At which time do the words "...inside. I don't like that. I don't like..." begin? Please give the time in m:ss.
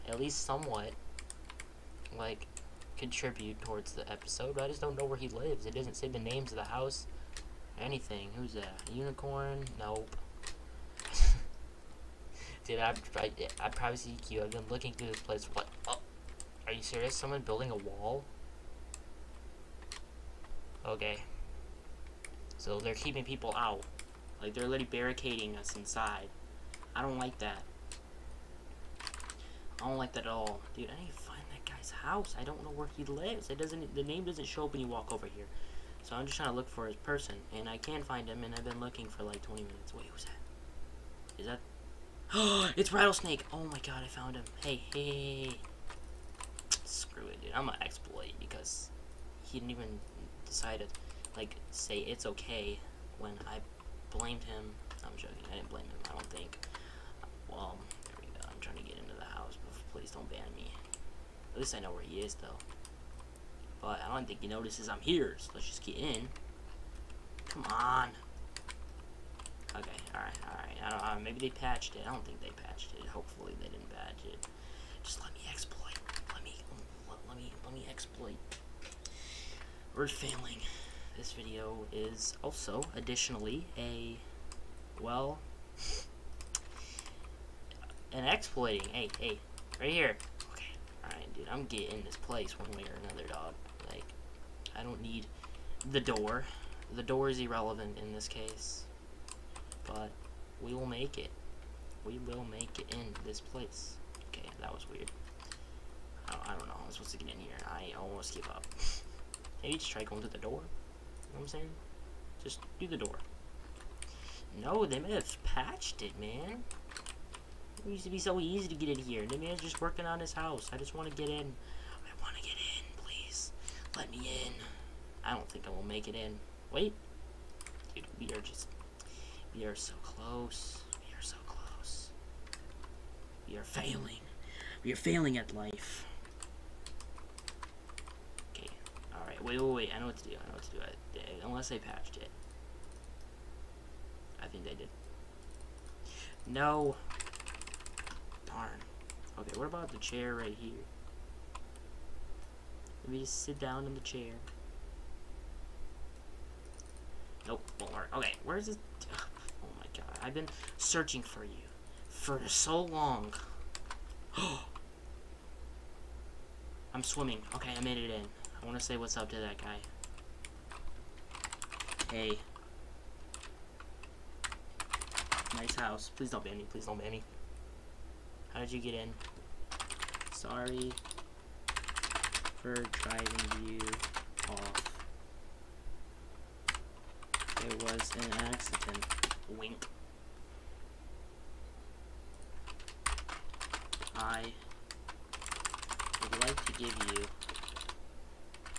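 0:25.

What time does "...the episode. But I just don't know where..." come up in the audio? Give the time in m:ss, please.
0:03.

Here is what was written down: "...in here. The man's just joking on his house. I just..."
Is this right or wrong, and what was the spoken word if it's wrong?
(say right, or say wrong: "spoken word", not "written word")
wrong: "working", not "joking".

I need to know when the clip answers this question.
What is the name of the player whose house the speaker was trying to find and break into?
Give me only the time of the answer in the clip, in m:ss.
0:42.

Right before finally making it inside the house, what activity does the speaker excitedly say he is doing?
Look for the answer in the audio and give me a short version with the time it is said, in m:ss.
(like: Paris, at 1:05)
Swimming, at 2:47.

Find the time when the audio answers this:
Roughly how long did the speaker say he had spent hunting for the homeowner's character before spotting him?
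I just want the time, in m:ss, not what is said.
0:39.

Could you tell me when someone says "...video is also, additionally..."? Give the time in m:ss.
1:21.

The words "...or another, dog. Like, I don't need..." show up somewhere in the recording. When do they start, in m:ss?
1:32.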